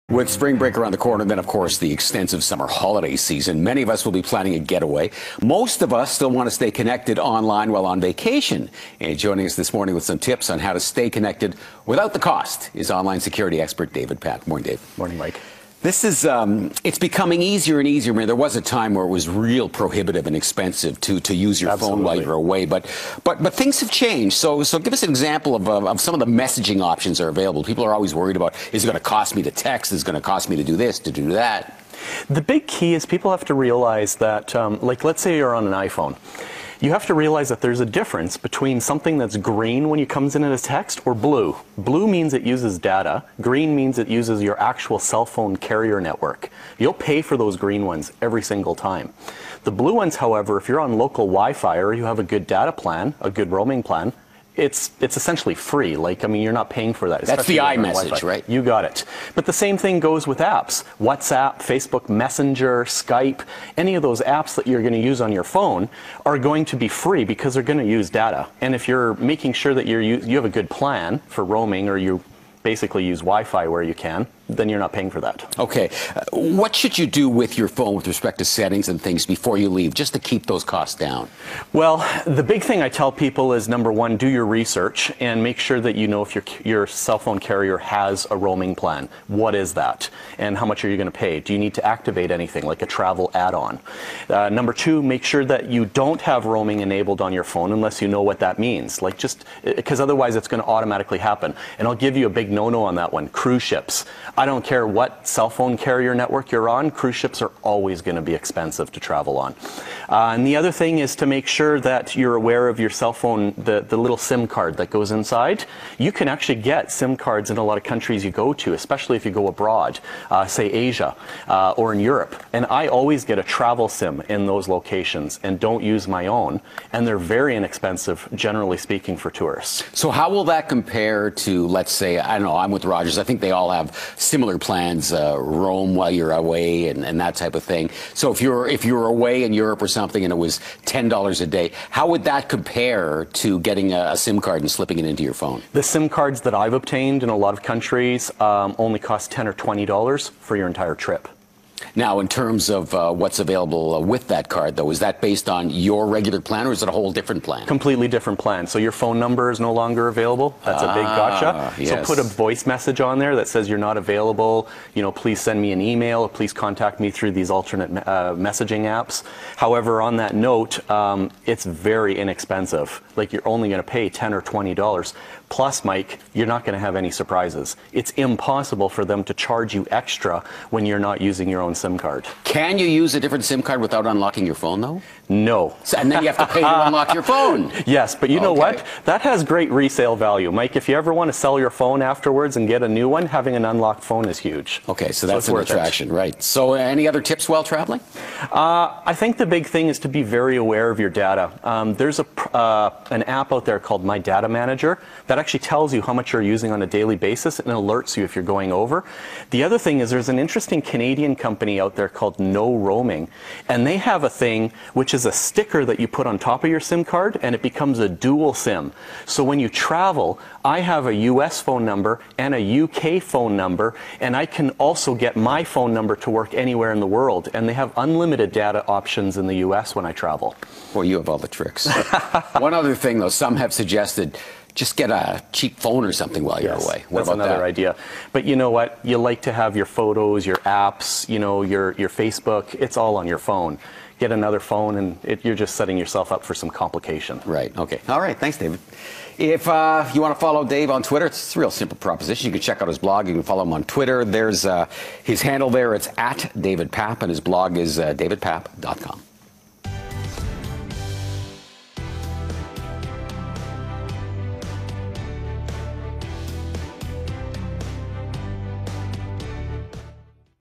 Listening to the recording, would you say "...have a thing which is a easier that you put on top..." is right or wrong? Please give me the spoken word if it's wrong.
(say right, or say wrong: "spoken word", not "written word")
wrong: "sticker", not "easier".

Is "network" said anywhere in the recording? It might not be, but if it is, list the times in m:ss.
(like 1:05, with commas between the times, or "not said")
0:46, 1:46.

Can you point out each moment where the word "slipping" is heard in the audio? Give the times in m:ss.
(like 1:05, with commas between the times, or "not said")
2:24.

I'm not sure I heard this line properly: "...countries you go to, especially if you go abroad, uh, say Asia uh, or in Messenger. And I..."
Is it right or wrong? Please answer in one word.
wrong.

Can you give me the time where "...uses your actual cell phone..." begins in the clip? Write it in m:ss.
0:44.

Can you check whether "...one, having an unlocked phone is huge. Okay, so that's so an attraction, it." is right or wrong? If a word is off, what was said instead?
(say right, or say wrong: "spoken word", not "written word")
right.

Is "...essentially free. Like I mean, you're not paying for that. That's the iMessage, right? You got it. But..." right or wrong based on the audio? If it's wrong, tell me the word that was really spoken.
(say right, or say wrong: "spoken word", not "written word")
right.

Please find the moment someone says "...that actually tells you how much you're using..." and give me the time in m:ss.
3:25.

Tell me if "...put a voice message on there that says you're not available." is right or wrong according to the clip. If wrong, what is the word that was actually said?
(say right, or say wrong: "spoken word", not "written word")
right.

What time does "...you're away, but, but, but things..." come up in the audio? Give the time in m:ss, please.
0:22.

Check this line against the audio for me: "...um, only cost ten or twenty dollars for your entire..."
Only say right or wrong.
right.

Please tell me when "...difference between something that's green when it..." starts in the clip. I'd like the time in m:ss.
0:37.